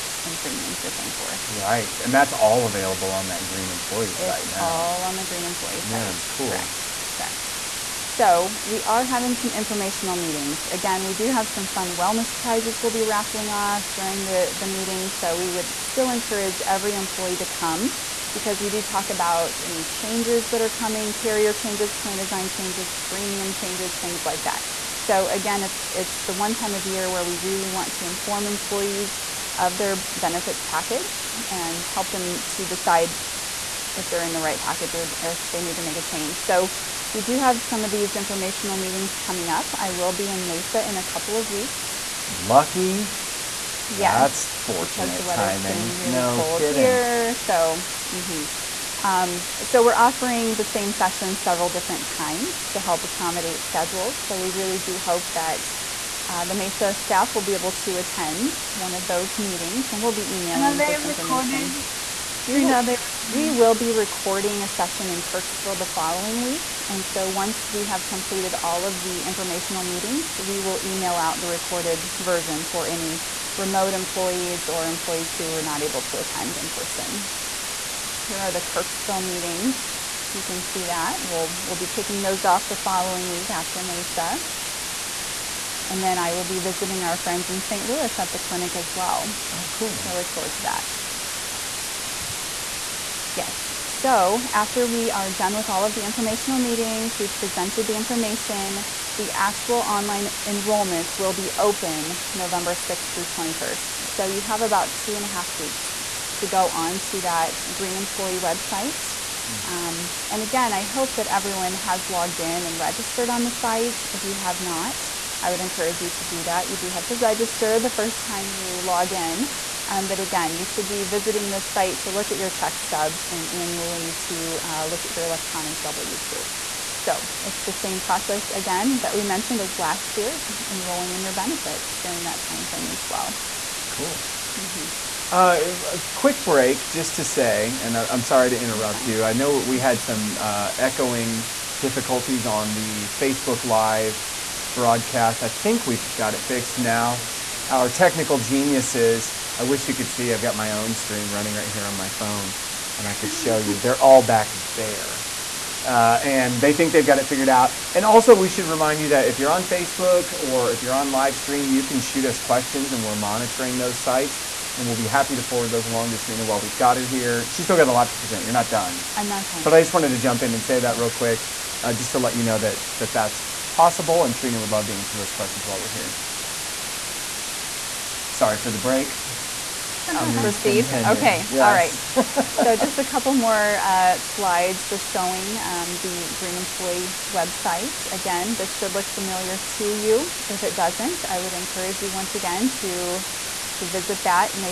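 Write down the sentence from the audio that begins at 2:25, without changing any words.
I think we've got it fixed now.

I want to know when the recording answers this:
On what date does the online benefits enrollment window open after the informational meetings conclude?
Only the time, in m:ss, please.
1:42.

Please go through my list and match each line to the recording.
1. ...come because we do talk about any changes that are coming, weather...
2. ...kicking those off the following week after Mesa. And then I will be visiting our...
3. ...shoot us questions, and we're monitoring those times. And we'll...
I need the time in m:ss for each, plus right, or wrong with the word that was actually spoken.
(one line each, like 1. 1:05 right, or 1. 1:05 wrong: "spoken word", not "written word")
1. 0:17 wrong: "carrier", not "weather"
2. 1:21 right
3. 2:41 wrong: "sites", not "times".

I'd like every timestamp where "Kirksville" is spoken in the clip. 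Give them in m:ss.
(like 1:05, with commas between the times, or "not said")
1:05, 1:18.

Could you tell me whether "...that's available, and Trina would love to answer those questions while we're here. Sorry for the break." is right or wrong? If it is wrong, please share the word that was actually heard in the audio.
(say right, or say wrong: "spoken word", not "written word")
wrong: "possible", not "available".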